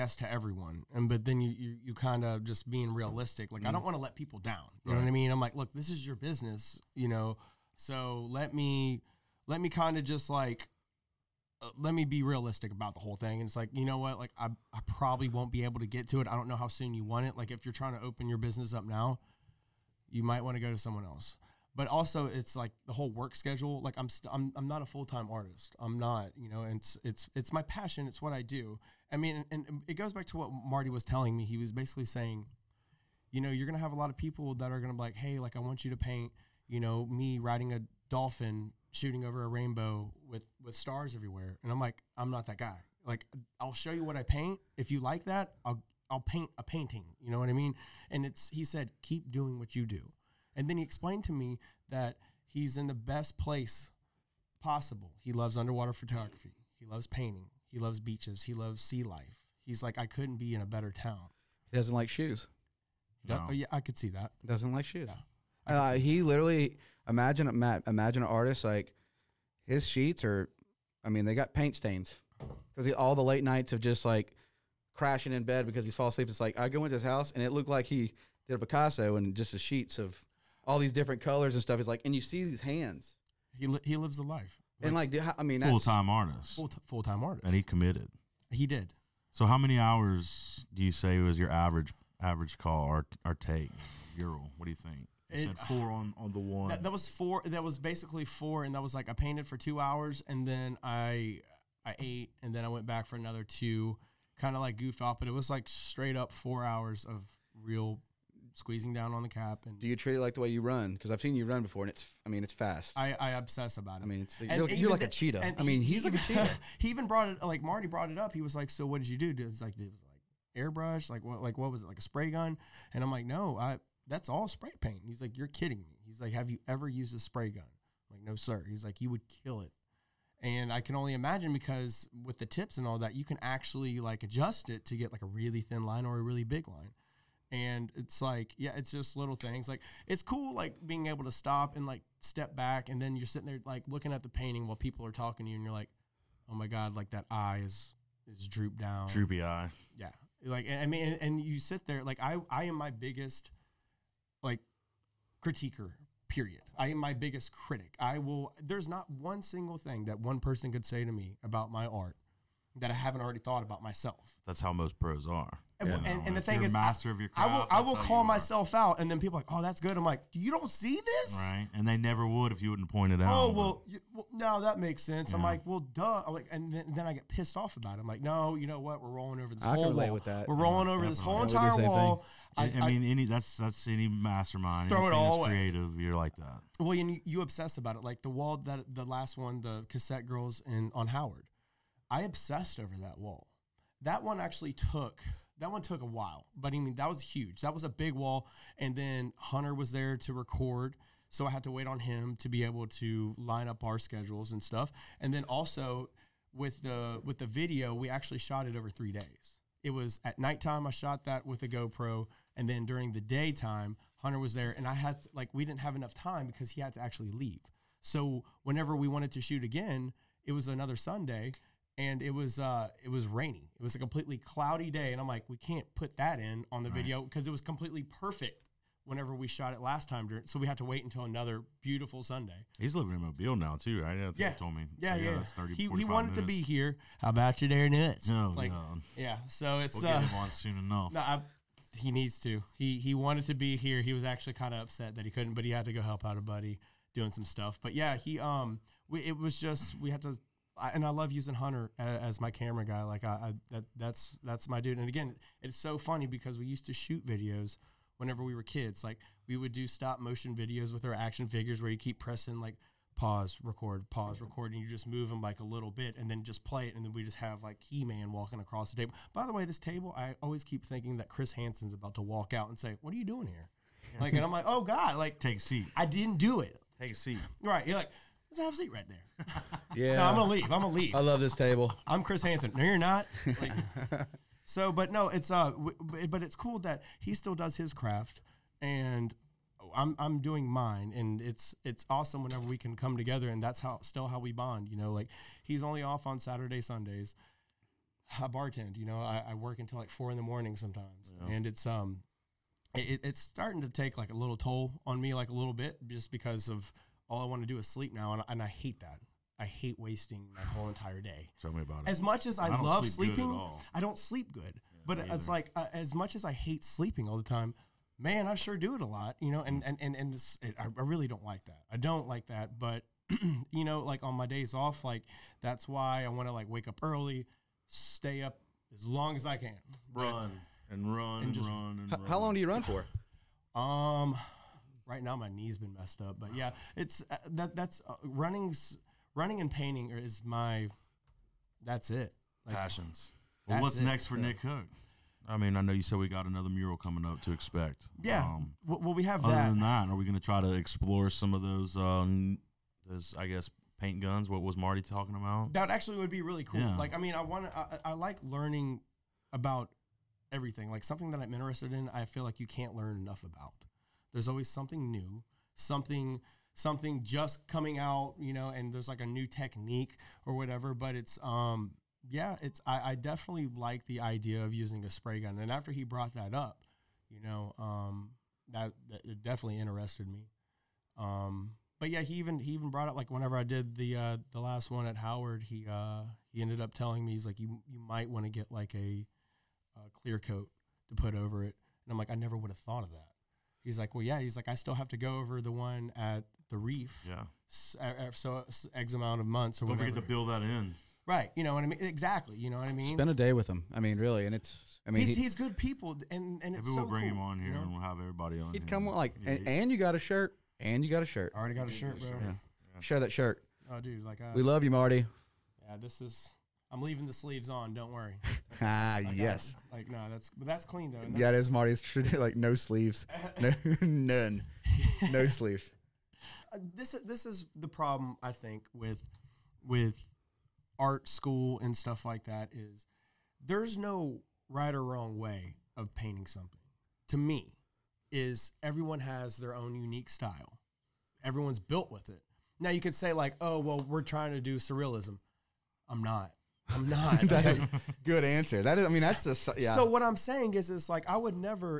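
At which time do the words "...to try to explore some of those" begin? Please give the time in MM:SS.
05:50.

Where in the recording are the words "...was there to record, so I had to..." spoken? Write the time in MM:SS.
03:19.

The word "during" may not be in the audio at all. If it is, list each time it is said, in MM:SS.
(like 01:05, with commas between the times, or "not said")
03:32, 03:50.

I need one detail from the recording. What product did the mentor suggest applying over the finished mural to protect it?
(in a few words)
Clear coat.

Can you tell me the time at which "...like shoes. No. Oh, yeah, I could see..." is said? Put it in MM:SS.
01:01.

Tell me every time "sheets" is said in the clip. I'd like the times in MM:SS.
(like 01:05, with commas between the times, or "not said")
01:09, 01:19.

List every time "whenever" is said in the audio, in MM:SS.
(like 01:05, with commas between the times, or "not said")
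03:38, 03:49, 04:18, 04:52, 06:23.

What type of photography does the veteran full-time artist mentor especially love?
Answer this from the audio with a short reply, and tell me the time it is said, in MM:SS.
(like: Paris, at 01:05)
Underwater photography, at 00:55.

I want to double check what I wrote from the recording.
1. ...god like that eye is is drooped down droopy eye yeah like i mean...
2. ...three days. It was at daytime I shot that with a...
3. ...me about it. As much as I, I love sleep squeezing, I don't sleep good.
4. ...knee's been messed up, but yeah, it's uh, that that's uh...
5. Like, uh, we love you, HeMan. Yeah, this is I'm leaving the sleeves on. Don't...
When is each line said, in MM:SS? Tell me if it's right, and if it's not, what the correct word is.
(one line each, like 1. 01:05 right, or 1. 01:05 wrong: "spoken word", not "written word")
1. 02:26 right
2. 03:28 wrong: "nighttime", not "daytime"
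3. 05:11 wrong: "sleeping", not "squeezing"
4. 05:35 right
5. 06:54 wrong: "Marty", not "HeMan".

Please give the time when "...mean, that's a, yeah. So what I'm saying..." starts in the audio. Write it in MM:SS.
07:29.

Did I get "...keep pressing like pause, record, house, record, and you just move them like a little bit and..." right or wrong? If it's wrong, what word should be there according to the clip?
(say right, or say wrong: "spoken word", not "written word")
wrong: "pause", not "house".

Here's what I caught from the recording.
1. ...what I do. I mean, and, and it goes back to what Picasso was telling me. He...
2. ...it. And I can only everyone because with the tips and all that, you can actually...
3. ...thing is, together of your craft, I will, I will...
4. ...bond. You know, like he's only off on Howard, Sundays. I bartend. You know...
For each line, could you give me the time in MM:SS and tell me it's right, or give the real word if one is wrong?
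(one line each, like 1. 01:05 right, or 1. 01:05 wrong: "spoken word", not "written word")
1. 00:28 wrong: "Marty", not "Picasso"
2. 02:09 wrong: "imagine", not "everyone"
3. 02:46 wrong: "master", not "together"
4. 04:54 wrong: "Saturday", not "Howard".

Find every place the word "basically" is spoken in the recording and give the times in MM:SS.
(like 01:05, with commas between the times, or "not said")
00:31, 01:37.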